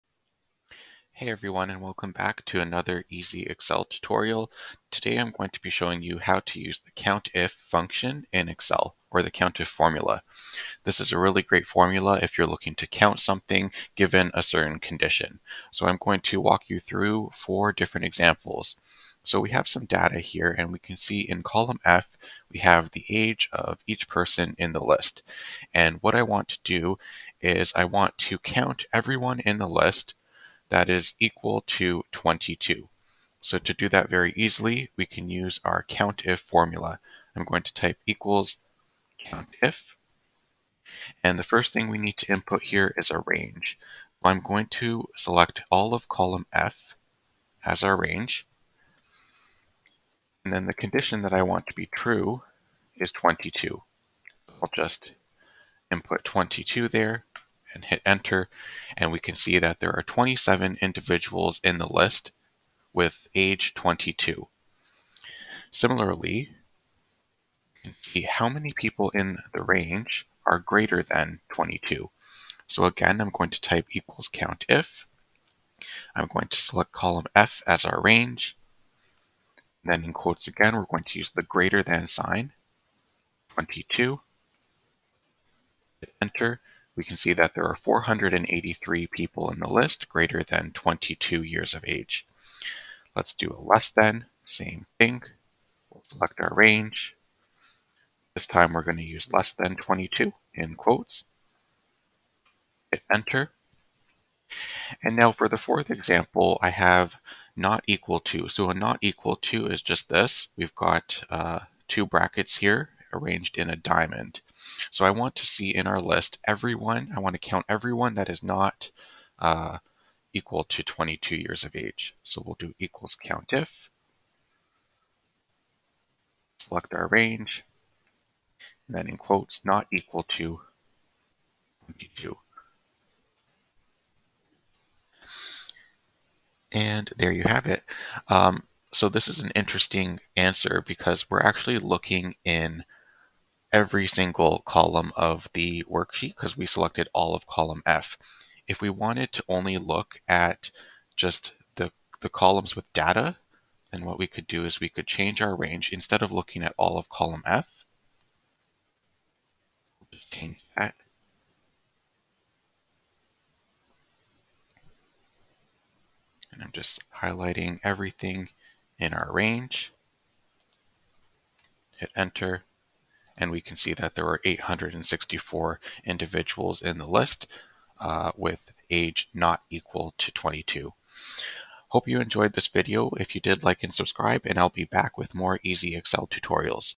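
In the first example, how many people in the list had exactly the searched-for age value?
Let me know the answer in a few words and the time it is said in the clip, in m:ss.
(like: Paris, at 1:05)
27, at 1:00.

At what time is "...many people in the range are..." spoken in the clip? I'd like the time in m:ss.
1:08.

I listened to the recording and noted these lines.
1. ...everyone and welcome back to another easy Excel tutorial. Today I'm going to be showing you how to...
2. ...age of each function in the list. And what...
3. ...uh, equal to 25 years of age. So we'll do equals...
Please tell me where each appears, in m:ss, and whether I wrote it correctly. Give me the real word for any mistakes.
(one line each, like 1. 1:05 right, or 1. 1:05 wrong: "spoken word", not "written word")
1. 0:01 right
2. 0:23 wrong: "person", not "function"
3. 1:59 wrong: "22", not "25".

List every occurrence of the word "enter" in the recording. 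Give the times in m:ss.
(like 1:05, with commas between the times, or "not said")
0:58, 1:26, 1:43, 2:52.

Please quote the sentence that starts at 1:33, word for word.
Let's do a less than, same thing.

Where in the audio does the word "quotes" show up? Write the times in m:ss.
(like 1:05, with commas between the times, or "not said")
1:20, 1:40, 2:09.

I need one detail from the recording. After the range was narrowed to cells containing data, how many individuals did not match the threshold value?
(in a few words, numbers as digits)
864.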